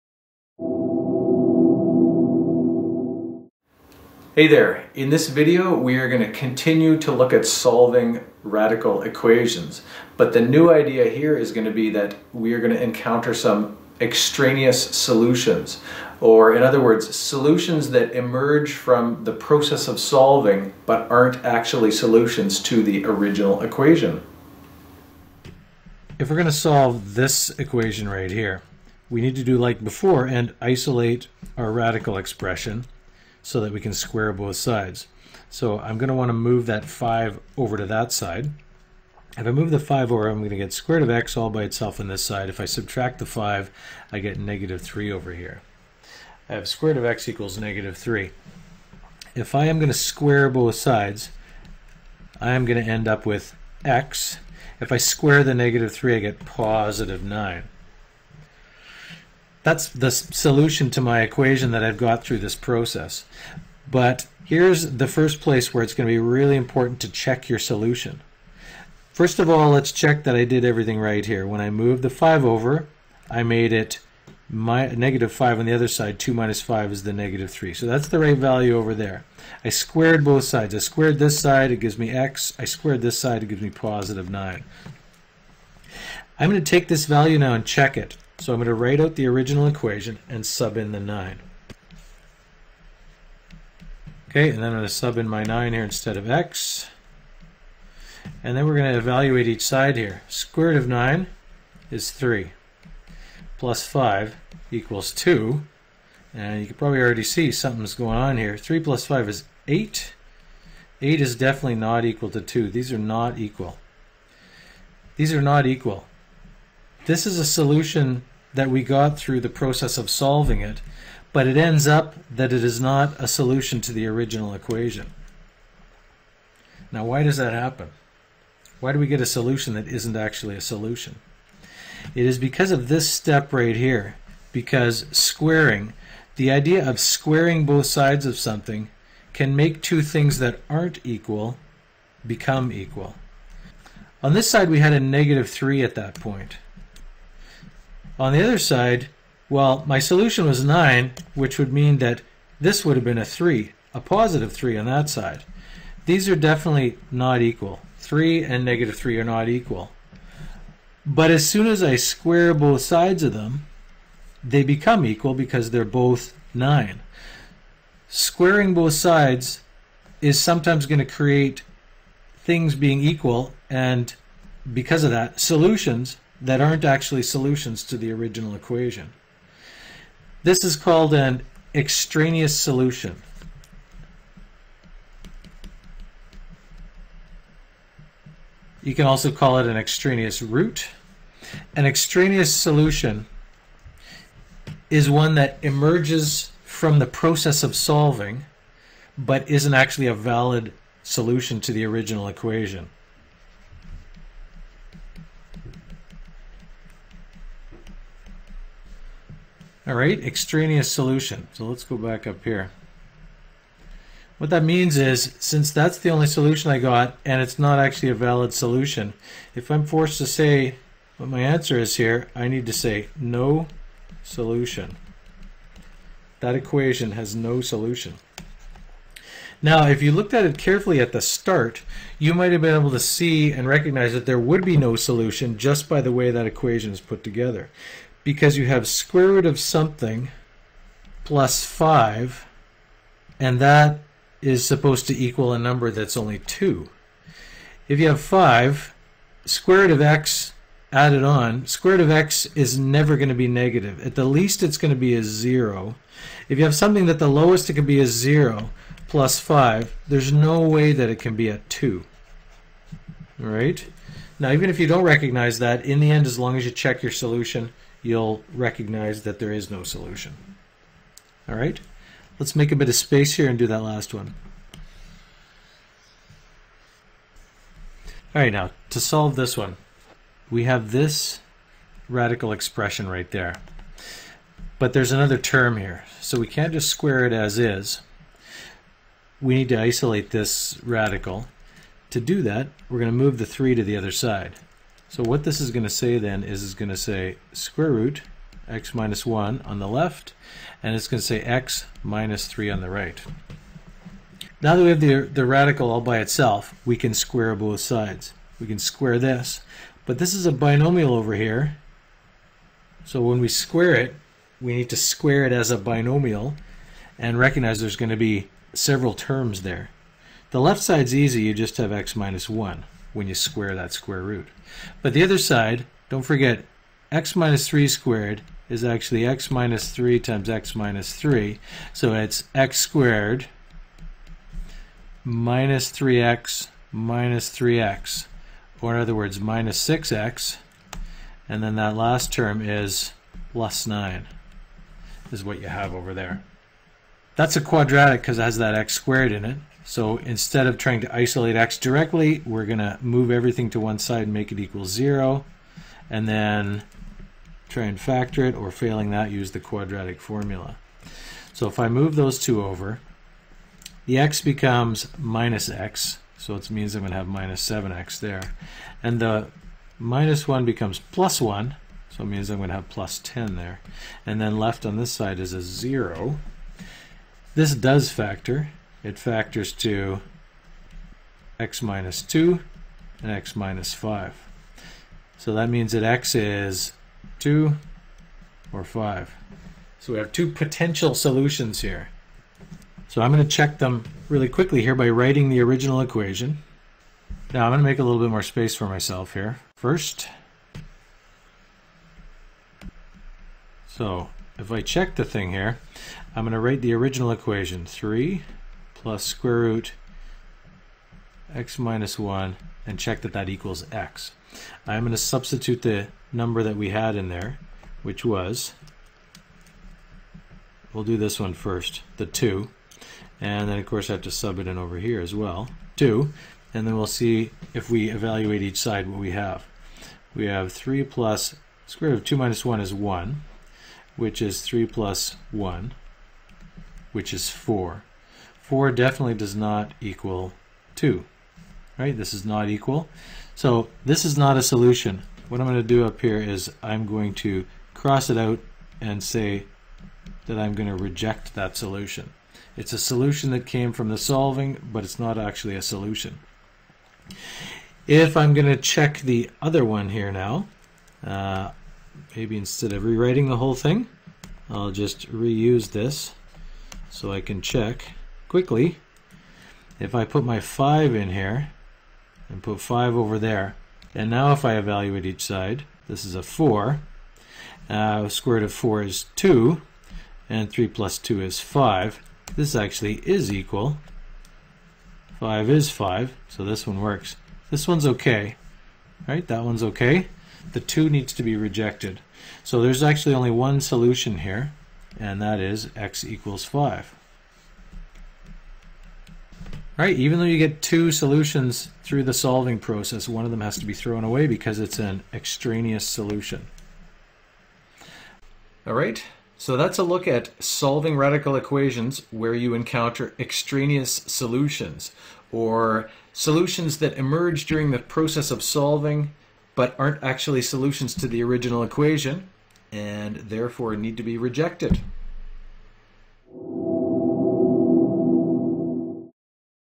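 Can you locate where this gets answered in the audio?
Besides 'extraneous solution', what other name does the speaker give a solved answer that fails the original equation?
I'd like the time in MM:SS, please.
03:09.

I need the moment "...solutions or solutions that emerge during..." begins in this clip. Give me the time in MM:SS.
08:34.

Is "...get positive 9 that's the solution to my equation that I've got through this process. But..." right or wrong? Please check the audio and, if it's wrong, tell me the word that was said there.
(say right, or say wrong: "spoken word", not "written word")
right.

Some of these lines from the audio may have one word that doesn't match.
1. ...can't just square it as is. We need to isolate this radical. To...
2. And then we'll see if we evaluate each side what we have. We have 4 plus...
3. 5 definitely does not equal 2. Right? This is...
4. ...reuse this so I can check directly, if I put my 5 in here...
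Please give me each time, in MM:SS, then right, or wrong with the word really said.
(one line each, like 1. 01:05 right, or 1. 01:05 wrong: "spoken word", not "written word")
1. 04:46 right
2. 07:06 wrong: "3", not "4"
3. 07:18 wrong: "4", not "5"
4. 07:45 wrong: "quickly", not "directly".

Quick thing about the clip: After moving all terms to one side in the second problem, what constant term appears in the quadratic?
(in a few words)
10.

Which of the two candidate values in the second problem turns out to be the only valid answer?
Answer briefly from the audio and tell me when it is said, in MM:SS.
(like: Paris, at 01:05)
5, at 08:15.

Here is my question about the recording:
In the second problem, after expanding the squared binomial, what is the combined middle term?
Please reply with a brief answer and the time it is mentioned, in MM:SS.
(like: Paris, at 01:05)
-6x, at 05:39.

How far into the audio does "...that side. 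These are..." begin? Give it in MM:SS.
02:34.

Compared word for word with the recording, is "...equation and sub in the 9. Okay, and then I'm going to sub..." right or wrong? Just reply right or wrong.
right.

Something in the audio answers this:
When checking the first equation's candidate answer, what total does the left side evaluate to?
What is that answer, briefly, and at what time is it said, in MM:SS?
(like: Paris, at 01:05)
8, at 01:48.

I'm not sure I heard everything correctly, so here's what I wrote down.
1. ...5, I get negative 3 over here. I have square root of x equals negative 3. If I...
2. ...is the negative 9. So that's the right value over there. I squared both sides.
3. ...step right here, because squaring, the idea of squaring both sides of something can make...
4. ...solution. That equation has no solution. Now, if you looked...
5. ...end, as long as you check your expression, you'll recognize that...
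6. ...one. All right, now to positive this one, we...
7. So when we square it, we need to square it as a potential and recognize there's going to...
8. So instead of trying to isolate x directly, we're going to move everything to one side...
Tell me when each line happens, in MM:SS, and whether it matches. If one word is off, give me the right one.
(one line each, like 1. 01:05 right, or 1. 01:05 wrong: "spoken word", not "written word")
1. 00:43 right
2. 01:16 wrong: "3", not "9"
3. 02:13 right
4. 03:44 right
5. 04:26 wrong: "solution", not "expression"
6. 04:34 wrong: "solve", not "positive"
7. 05:13 wrong: "binomial", not "potential"
8. 05:49 right.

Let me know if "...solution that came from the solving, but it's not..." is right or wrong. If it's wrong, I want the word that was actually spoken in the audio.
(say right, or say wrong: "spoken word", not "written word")
right.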